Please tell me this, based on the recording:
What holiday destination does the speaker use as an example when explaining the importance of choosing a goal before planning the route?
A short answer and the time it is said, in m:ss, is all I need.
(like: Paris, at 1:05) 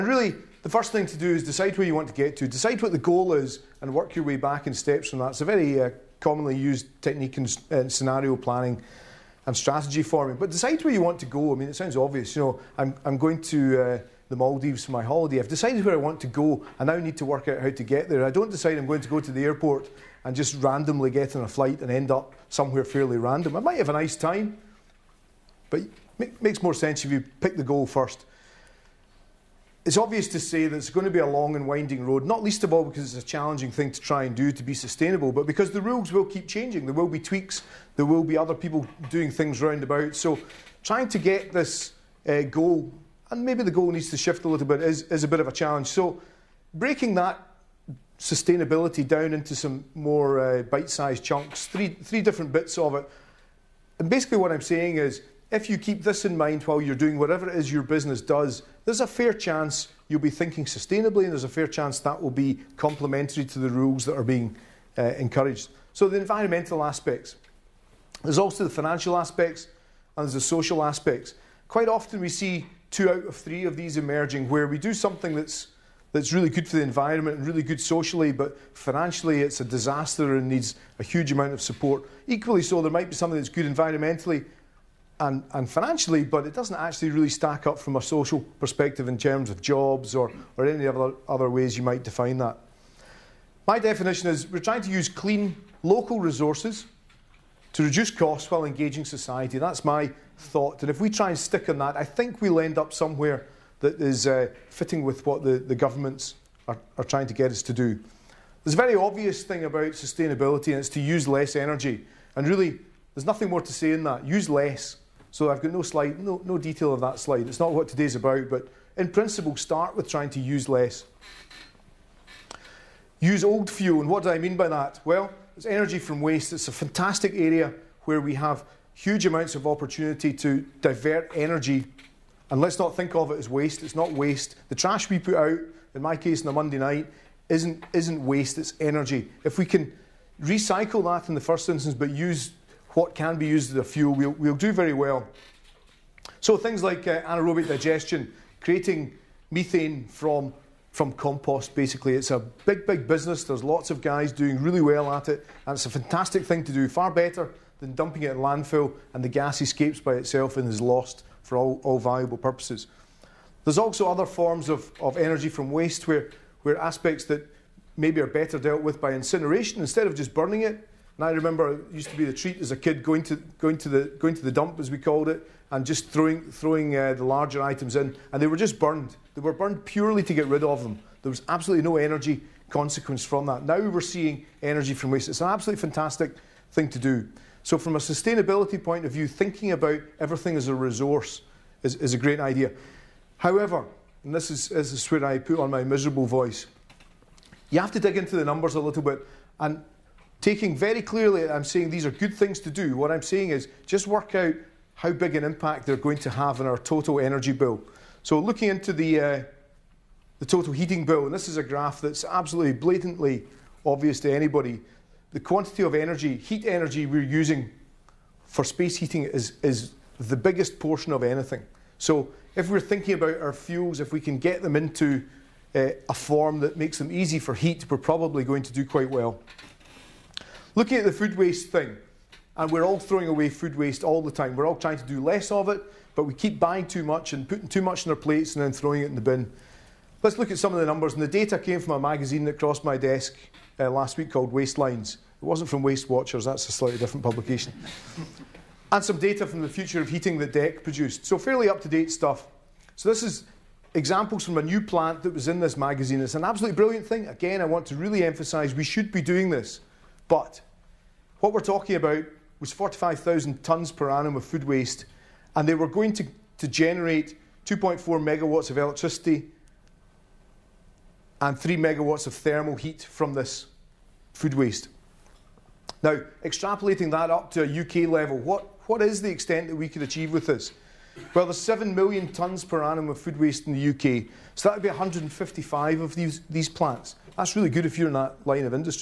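The Maldives, at 0:14.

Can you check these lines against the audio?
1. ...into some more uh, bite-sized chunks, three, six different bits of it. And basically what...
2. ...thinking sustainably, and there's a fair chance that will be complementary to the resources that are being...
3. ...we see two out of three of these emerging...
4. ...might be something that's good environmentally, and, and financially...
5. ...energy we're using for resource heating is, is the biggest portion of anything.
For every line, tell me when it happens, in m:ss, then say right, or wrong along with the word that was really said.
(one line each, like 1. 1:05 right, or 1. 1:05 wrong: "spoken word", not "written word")
1. 0:49 wrong: "three", not "six"
2. 1:00 wrong: "rules", not "resources"
3. 1:12 right
4. 1:22 right
5. 3:36 wrong: "space", not "resource".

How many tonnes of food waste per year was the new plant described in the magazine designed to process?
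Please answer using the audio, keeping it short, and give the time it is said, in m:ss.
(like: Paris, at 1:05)
45,000 tonnes, at 4:22.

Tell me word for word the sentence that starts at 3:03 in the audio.
Now we're seeing energy from waste.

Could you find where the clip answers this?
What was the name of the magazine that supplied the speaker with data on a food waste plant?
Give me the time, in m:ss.
4:04.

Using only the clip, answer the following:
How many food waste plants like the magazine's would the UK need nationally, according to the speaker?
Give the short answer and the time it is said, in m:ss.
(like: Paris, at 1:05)
155, at 4:44.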